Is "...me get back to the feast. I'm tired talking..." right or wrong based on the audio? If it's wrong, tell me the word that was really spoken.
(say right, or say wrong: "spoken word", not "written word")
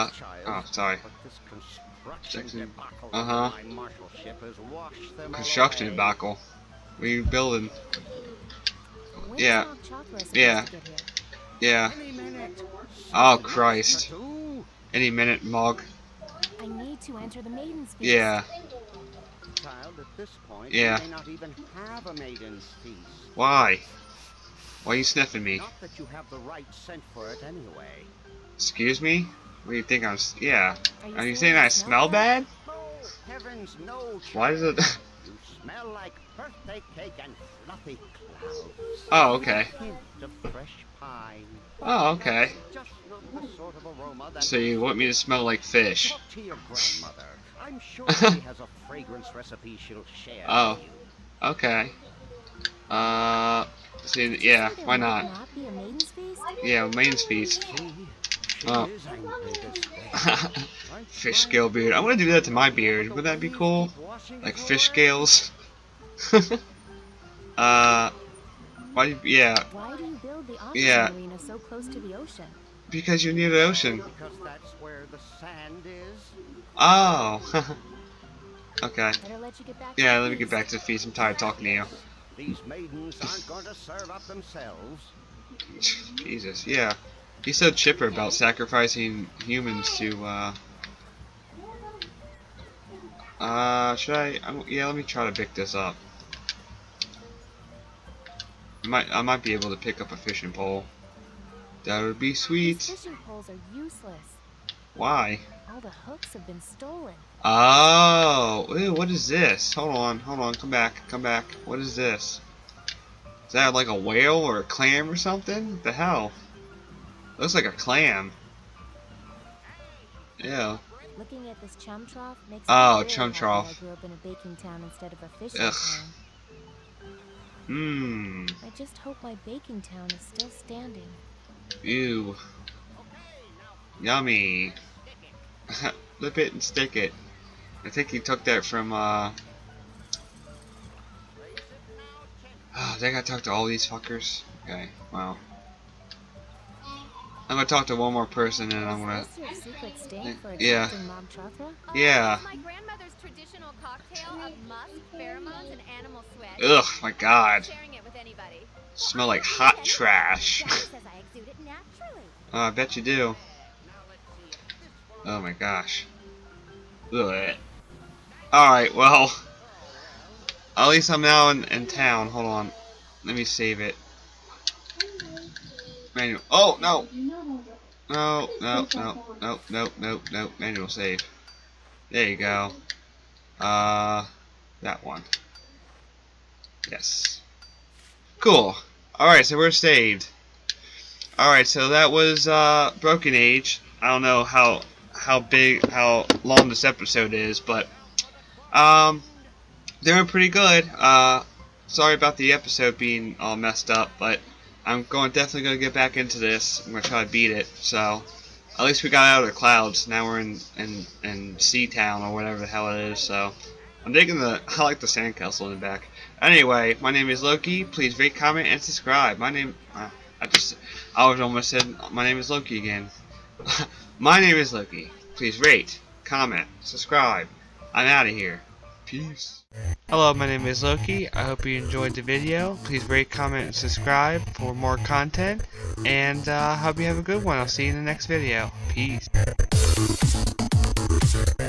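right.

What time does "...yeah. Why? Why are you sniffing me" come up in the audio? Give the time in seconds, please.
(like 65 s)
20 s.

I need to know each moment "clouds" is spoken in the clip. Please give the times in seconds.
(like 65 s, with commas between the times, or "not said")
38 s, 209 s.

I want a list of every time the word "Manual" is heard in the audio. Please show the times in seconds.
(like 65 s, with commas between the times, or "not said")
176 s, 180 s.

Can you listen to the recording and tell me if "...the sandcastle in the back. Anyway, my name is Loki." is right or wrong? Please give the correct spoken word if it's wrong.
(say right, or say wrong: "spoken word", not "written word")
right.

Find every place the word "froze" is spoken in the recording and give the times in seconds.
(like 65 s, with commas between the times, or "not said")
not said.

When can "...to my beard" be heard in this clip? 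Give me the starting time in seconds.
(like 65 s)
62 s.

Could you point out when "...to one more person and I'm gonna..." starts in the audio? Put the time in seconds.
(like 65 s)
147 s.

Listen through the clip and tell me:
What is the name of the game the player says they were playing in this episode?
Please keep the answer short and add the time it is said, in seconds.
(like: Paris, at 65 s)
Broken Age, at 193 s.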